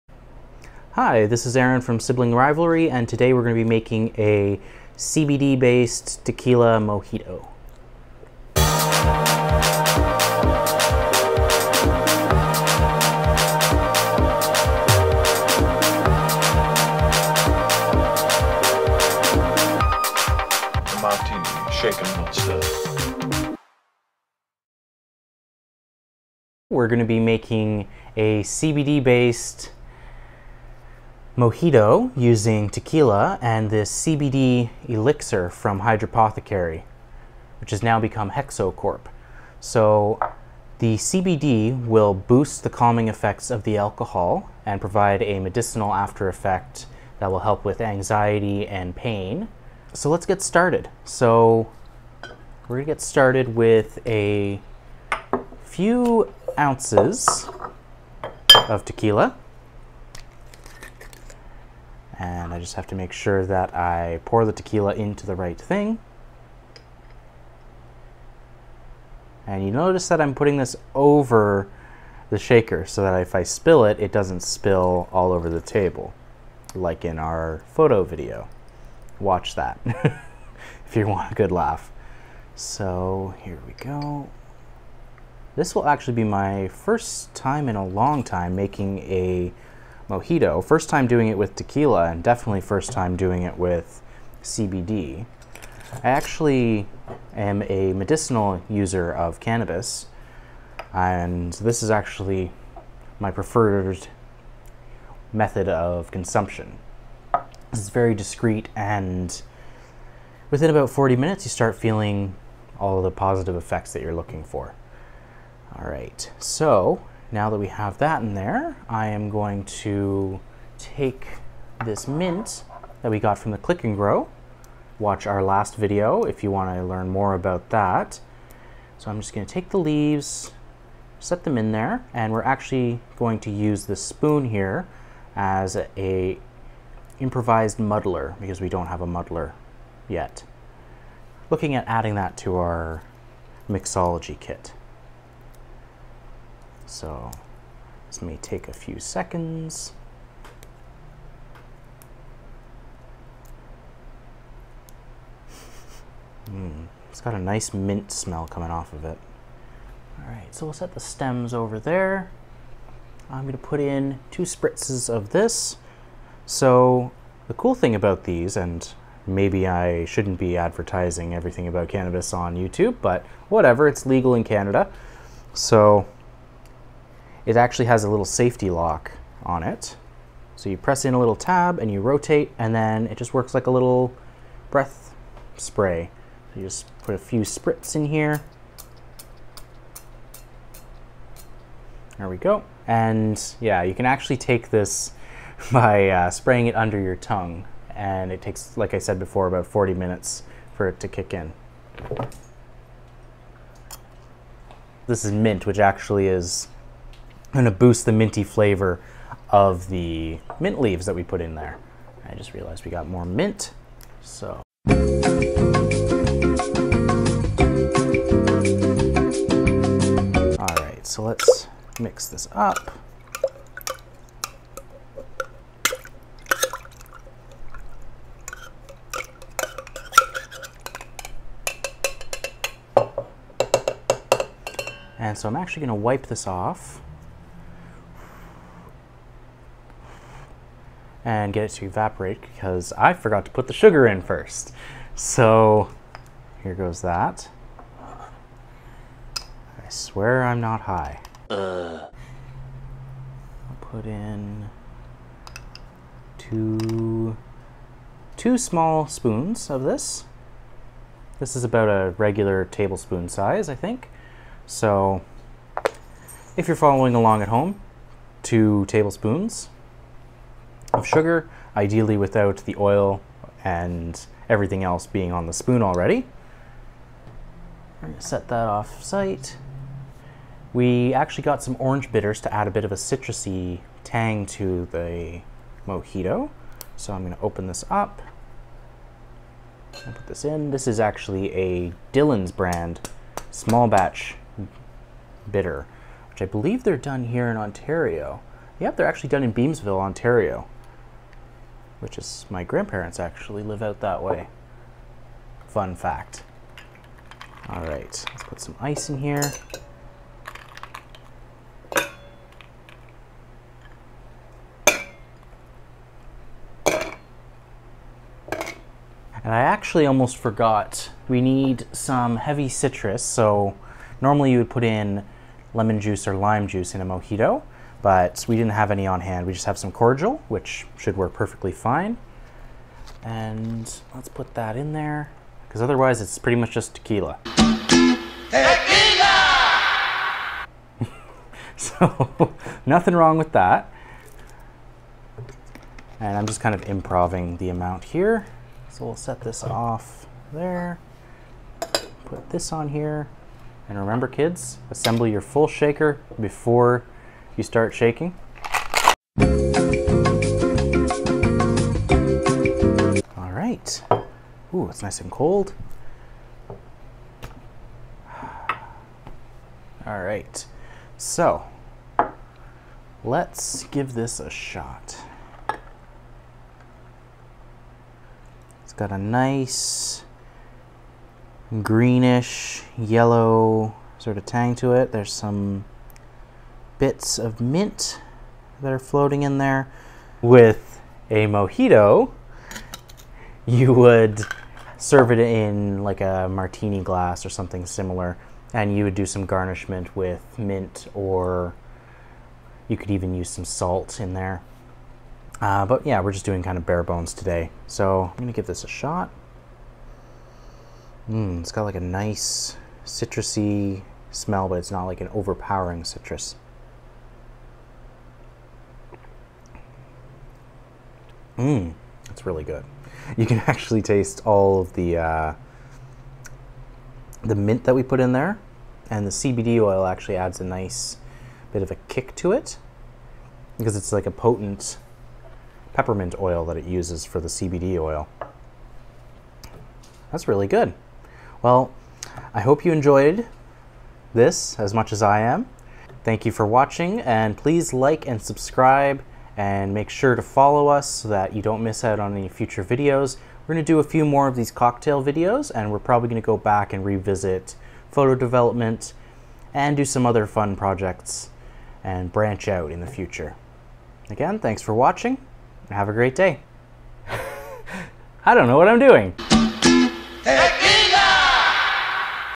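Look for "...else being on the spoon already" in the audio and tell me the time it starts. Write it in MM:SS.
04:34.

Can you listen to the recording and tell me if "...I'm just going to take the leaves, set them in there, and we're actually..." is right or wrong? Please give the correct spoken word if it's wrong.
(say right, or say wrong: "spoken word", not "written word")
right.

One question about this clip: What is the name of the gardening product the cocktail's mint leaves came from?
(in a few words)
Click and Grow.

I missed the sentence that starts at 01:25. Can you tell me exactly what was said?
This will actually be my first time in a long time making a mojito.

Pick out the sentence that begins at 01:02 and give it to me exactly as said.
And I just have to make sure that I pour the tequila into the right thing.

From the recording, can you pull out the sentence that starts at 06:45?
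Uh, but yeah, we're just doing kind of bare bones today.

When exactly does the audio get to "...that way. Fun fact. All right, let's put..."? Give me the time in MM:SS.
05:04.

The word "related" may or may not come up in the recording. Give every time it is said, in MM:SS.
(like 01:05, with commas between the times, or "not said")
not said.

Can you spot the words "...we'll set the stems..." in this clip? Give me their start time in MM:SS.
02:40.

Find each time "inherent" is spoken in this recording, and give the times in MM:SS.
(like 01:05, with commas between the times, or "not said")
not said.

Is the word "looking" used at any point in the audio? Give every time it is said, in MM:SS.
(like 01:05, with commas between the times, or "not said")
01:54, 02:21.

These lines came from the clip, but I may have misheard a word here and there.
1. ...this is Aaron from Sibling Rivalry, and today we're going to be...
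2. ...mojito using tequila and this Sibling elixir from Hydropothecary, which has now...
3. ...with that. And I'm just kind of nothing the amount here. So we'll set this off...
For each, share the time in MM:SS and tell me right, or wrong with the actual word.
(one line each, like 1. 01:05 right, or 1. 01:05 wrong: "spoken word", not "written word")
1. 00:01 right
2. 00:31 wrong: "CBD", not "Sibling"
3. 05:43 wrong: "improvising", not "nothing".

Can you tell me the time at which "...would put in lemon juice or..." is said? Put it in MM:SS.
05:24.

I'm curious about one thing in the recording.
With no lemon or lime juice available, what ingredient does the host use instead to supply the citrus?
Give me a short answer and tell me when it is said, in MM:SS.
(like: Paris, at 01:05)
cordial, at 05:29.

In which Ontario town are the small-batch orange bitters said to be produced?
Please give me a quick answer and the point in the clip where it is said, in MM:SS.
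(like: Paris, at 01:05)
Beamsville, at 04:59.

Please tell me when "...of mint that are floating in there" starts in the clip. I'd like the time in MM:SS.
06:27.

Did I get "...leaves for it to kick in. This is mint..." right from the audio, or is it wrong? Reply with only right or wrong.
wrong.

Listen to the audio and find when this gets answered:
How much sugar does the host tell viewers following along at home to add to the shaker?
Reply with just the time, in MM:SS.
04:28.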